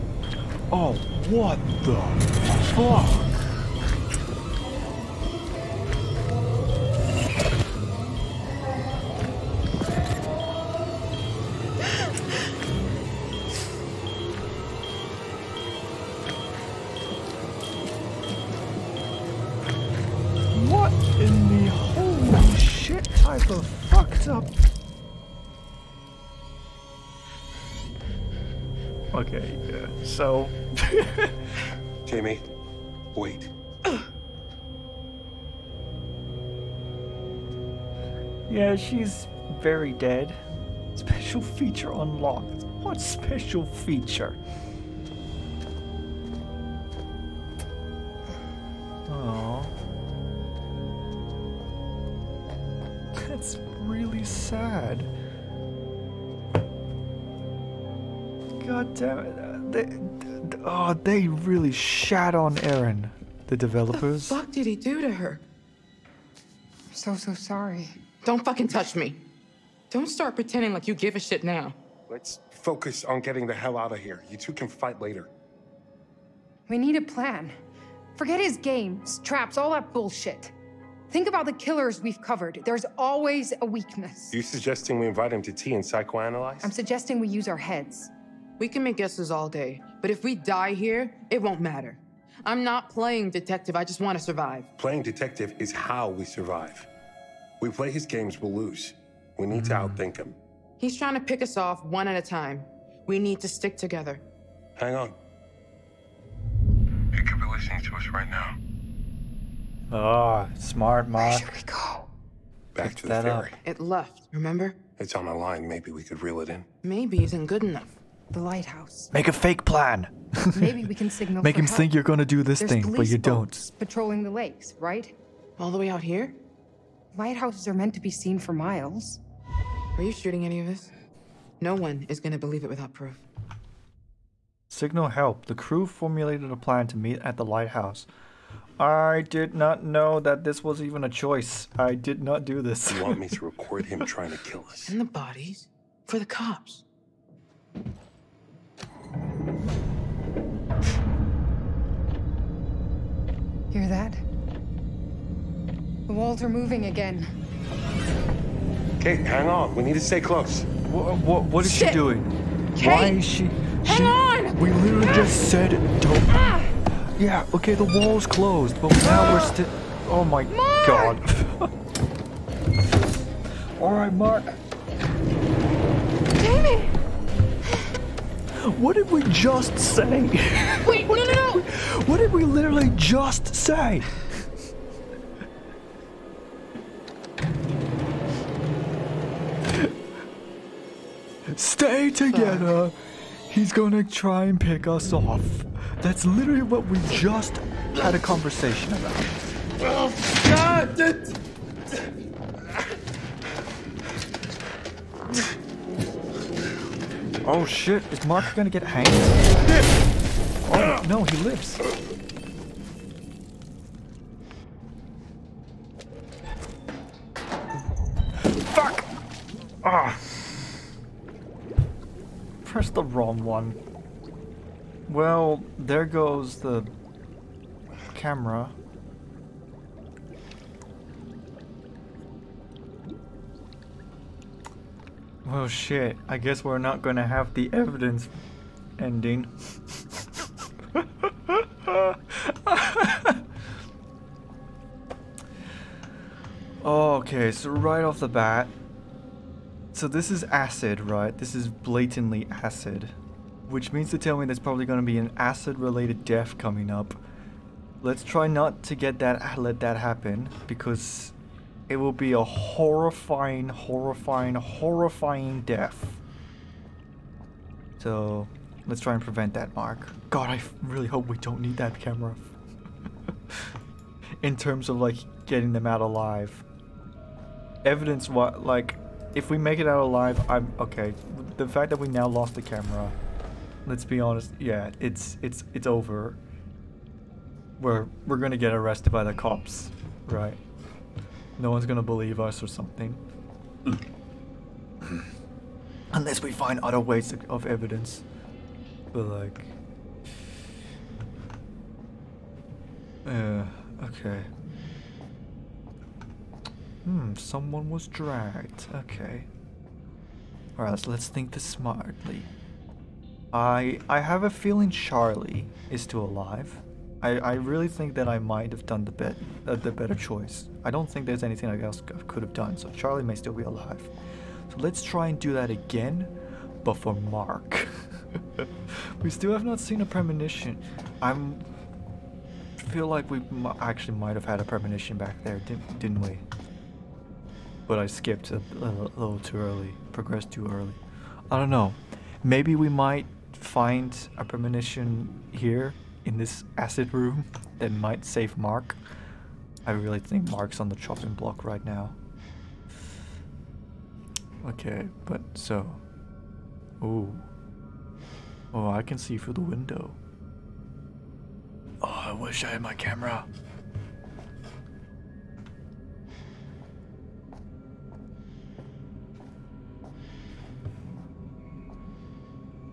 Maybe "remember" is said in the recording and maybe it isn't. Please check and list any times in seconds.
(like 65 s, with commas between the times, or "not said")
114 s.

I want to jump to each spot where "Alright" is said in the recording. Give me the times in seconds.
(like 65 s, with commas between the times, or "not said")
310 s.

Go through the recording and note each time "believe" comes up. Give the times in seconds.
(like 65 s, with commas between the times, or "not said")
132 s, 292 s.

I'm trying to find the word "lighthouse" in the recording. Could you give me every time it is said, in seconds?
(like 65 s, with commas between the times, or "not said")
118 s, 127 s, 137 s.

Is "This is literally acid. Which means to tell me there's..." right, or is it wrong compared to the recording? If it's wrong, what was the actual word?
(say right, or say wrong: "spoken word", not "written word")
wrong: "blatantly", not "literally".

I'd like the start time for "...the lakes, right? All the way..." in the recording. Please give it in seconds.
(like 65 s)
124 s.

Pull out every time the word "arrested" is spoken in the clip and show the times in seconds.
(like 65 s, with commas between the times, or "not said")
288 s.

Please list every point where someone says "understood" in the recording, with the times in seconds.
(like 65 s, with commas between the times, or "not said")
not said.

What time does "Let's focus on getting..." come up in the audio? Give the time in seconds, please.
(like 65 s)
72 s.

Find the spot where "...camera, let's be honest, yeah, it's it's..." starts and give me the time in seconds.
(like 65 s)
282 s.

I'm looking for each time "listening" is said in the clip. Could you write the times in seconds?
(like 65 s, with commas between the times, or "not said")
107 s.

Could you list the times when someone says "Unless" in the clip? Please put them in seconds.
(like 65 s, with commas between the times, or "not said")
296 s.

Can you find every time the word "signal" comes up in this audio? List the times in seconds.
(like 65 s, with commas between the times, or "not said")
121 s, 134 s.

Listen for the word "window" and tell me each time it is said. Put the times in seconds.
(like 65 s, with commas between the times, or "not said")
359 s.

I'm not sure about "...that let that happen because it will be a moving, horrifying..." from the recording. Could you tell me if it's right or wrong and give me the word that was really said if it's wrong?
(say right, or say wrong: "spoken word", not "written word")
wrong: "horrifying", not "moving".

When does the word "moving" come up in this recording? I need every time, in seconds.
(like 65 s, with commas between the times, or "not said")
156 s.